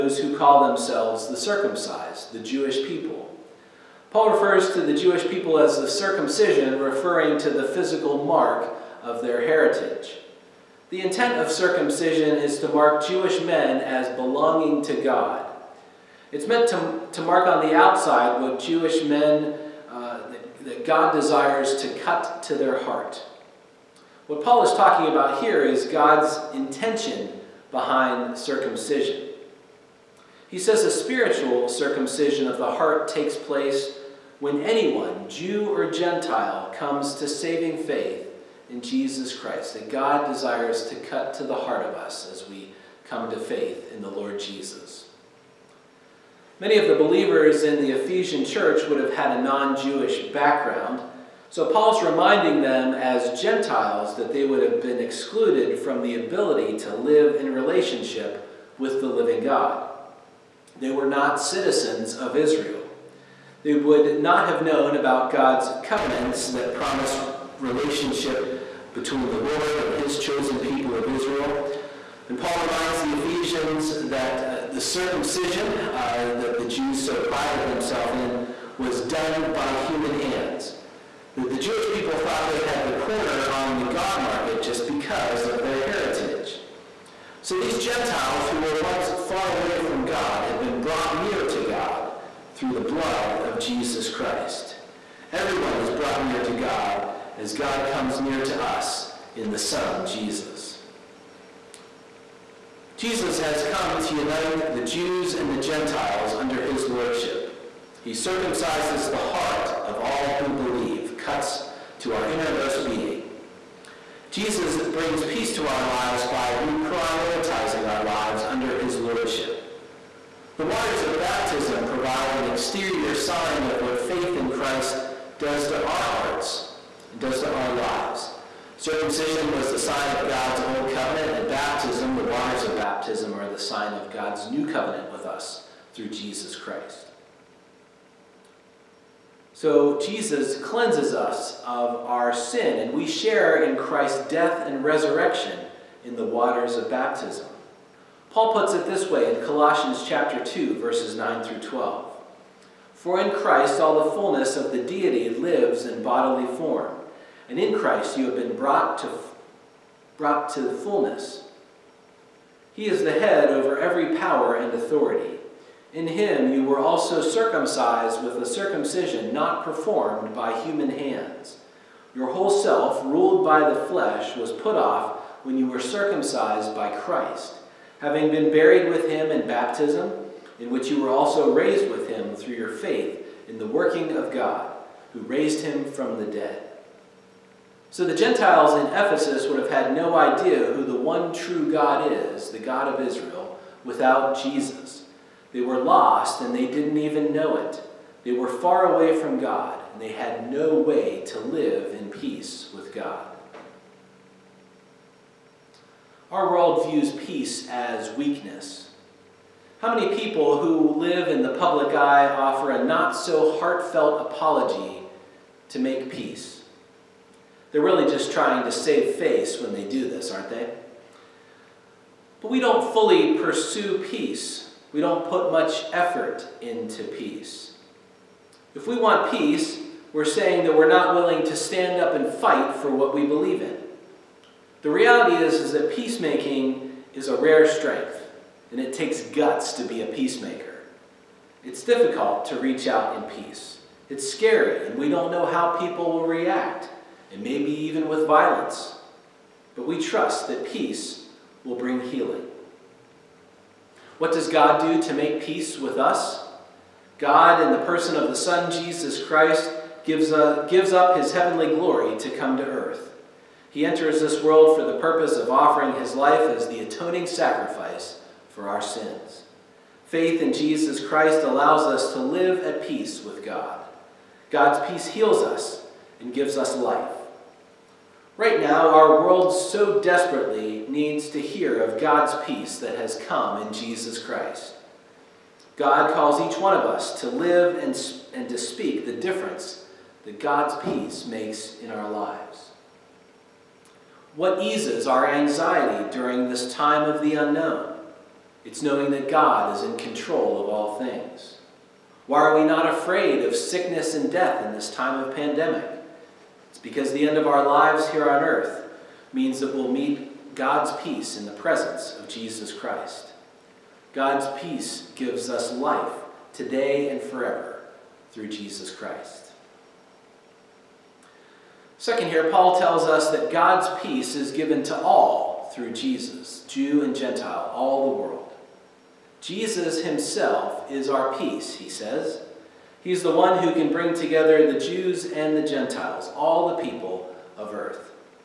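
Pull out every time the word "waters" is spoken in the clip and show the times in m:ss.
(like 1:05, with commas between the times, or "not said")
2:00, 2:12, 2:26.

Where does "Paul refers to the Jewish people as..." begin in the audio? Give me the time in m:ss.
0:04.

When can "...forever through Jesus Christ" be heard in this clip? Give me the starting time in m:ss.
5:17.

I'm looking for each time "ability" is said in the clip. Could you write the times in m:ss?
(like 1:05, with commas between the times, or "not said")
0:56.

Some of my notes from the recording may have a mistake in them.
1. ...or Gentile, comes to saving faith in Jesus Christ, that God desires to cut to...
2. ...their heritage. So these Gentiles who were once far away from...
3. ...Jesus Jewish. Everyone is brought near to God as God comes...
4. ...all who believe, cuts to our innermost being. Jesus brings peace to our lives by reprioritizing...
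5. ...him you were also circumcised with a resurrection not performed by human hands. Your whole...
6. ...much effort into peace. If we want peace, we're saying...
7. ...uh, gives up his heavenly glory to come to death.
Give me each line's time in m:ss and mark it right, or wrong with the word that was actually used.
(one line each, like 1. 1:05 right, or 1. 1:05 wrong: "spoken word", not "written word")
1. 0:35 right
2. 1:25 right
3. 1:33 wrong: "Christ", not "Jewish"
4. 1:49 right
5. 2:46 wrong: "circumcision", not "resurrection"
6. 3:45 right
7. 4:20 wrong: "earth", not "death".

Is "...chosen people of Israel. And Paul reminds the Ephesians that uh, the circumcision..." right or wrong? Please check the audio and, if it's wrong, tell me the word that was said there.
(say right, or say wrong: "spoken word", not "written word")
right.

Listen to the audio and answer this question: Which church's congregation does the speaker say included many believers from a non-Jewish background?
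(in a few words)
Ephesian church.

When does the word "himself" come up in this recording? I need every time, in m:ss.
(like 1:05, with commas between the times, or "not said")
5:30.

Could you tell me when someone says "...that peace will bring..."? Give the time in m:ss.
4:10.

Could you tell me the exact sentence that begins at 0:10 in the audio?
The intent of circumcision is to mark Jewish men as belonging to God.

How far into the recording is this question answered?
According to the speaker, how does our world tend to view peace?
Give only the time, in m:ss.
3:27.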